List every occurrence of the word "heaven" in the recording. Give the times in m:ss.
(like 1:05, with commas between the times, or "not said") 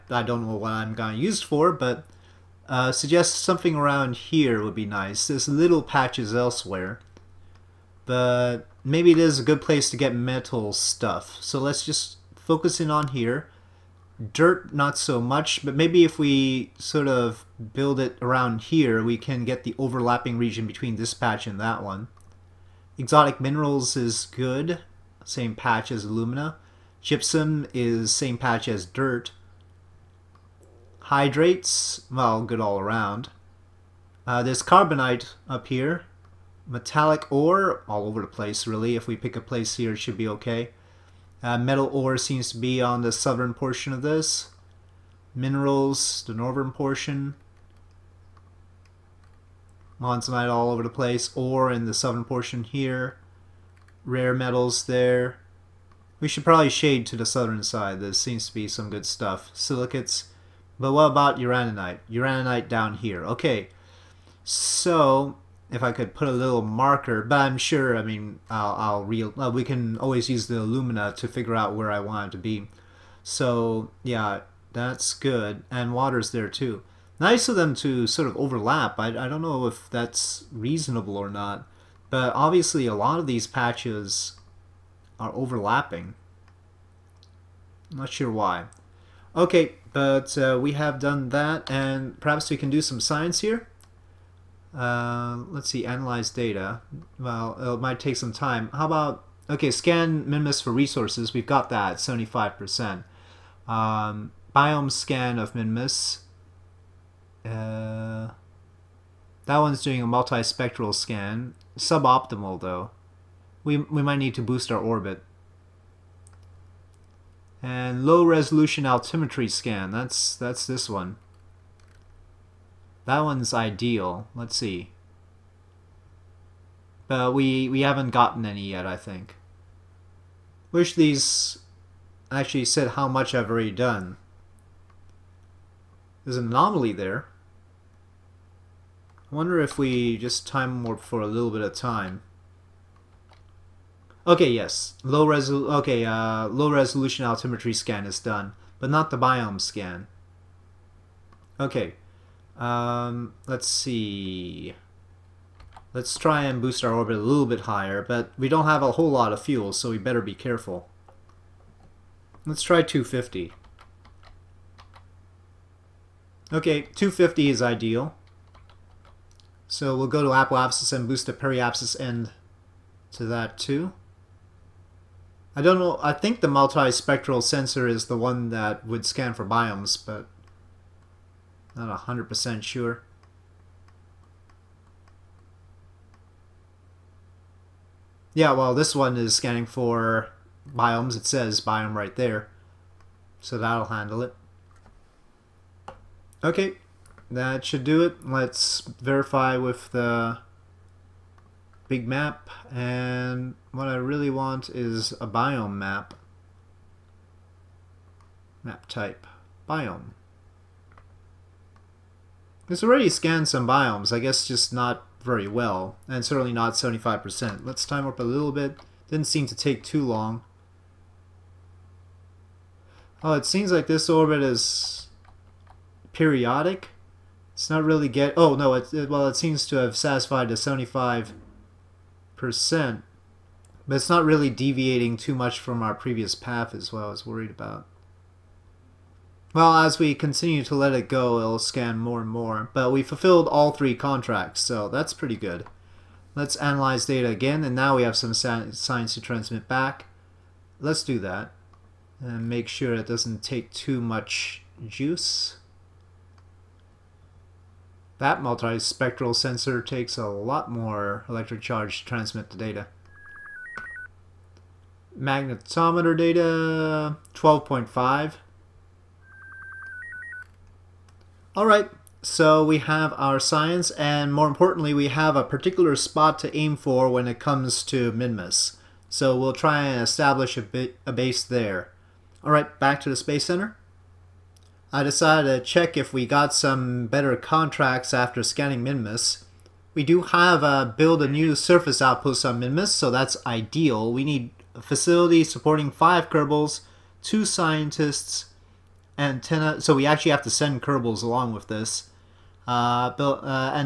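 not said.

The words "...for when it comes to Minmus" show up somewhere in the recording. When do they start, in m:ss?
4:36.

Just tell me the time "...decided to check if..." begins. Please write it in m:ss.
4:45.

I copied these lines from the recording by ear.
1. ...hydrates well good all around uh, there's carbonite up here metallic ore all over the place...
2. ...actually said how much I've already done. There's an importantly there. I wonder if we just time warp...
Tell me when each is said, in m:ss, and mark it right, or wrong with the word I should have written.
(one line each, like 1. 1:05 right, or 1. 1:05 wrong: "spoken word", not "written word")
1. 0:31 right
2. 2:12 wrong: "anomaly", not "importantly".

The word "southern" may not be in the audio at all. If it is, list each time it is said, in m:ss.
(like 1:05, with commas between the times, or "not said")
0:43, 0:51, 0:57.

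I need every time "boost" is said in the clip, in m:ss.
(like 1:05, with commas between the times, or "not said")
1:54, 2:36, 2:51.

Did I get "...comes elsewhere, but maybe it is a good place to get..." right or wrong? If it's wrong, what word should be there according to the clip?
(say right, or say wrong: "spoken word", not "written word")
wrong: "patches", not "comes".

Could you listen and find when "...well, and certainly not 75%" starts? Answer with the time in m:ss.
3:35.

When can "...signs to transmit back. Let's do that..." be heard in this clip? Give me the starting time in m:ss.
4:08.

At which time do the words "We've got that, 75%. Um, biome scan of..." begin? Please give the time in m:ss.
1:41.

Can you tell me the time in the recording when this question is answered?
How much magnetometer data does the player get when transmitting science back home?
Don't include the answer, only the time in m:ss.
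4:27.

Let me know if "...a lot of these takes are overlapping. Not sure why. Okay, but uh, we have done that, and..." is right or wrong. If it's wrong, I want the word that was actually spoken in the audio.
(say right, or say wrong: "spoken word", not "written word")
wrong: "patches", not "takes".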